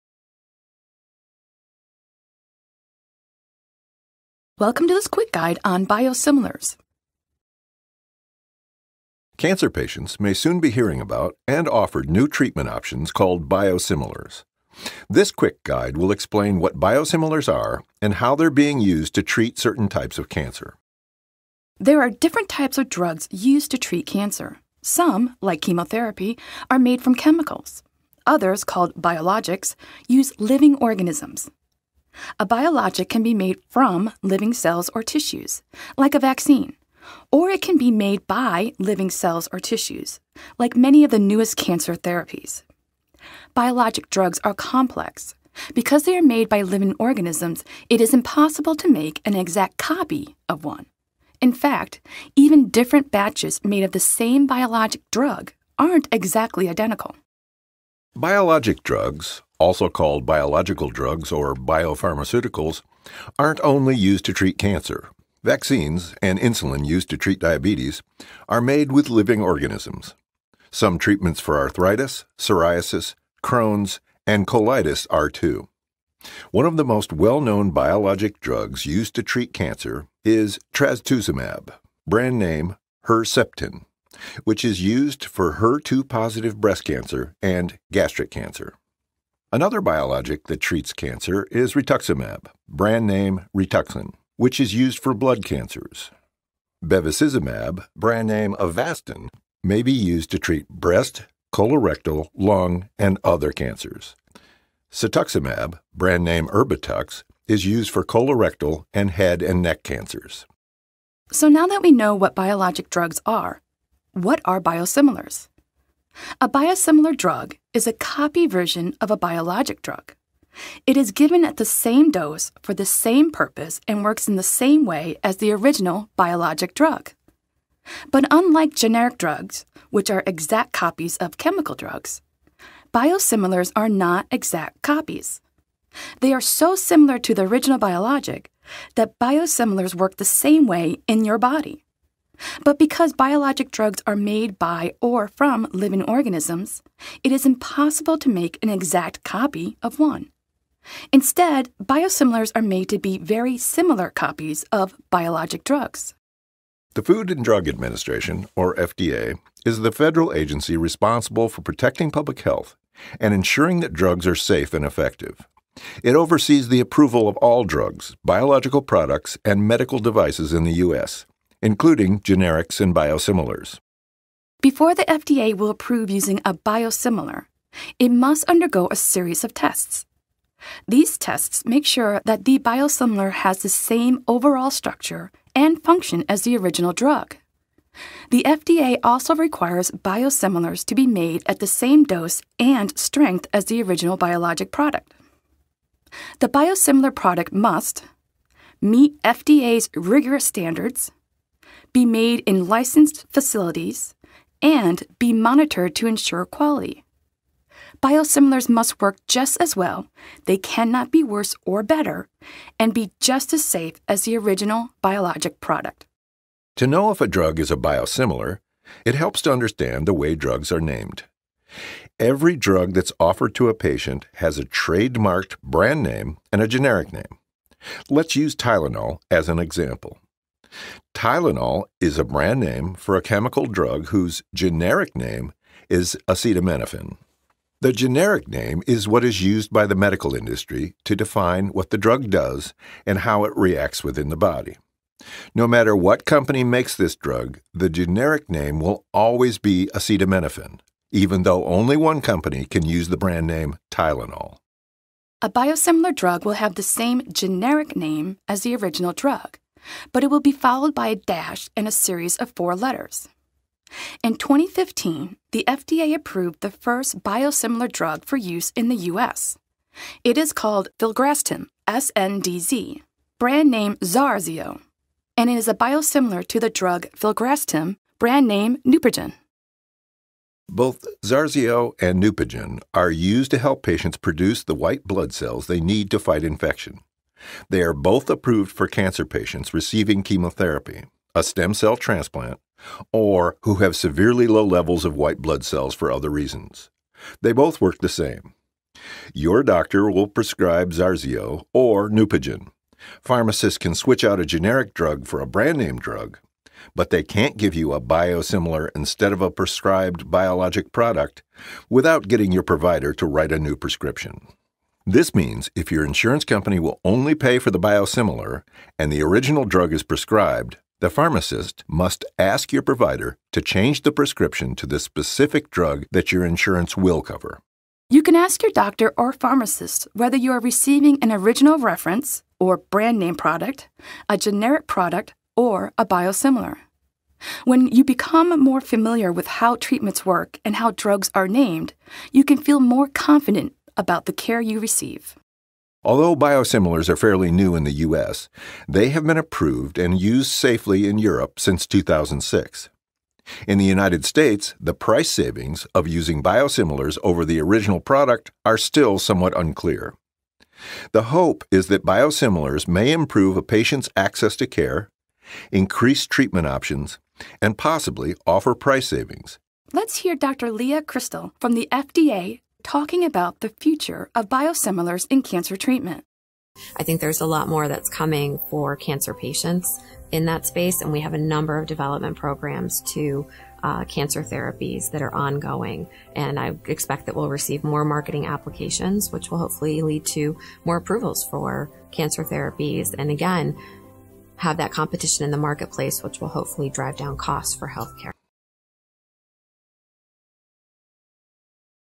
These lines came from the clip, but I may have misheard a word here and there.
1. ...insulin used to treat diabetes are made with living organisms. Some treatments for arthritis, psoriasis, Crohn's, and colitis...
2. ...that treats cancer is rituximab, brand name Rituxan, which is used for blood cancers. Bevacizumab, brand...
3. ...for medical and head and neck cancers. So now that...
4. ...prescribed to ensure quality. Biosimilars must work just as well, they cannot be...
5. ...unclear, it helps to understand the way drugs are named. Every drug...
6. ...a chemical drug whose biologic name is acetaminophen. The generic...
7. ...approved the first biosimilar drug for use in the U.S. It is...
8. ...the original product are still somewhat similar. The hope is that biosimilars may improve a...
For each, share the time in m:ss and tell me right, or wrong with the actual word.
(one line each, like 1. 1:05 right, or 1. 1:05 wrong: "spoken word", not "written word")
1. 1:06 right
2. 1:30 right
3. 1:47 wrong: "colorectal", not "medical"
4. 3:25 wrong: "monitored", not "prescribed"
5. 3:37 wrong: "biosimilar", not "unclear"
6. 3:53 wrong: "generic", not "biologic"
7. 4:26 right
8. 5:57 wrong: "unclear", not "similar".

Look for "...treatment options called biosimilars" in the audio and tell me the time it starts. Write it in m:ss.
0:12.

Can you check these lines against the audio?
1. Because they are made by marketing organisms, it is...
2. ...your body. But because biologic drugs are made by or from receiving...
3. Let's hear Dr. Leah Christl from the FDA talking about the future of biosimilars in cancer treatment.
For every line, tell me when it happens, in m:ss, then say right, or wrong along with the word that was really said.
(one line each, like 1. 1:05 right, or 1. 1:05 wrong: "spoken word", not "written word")
1. 0:45 wrong: "living", not "marketing"
2. 2:21 wrong: "living", not "receiving"
3. 6:09 right.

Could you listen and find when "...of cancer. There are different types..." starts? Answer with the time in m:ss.
0:20.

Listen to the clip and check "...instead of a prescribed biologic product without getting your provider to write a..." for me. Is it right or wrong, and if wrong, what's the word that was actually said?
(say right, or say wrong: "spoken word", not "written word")
right.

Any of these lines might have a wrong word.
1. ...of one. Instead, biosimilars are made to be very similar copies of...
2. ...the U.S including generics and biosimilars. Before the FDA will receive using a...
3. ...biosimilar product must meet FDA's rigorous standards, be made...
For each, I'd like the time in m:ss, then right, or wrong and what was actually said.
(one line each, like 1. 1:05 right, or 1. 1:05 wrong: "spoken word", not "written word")
1. 2:29 right
2. 2:50 wrong: "approve", not "receive"
3. 3:16 right.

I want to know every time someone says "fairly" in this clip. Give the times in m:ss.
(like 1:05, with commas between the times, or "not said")
5:47.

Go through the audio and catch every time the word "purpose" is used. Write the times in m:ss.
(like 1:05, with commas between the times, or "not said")
2:03.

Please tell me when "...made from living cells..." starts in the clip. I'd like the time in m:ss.
0:33.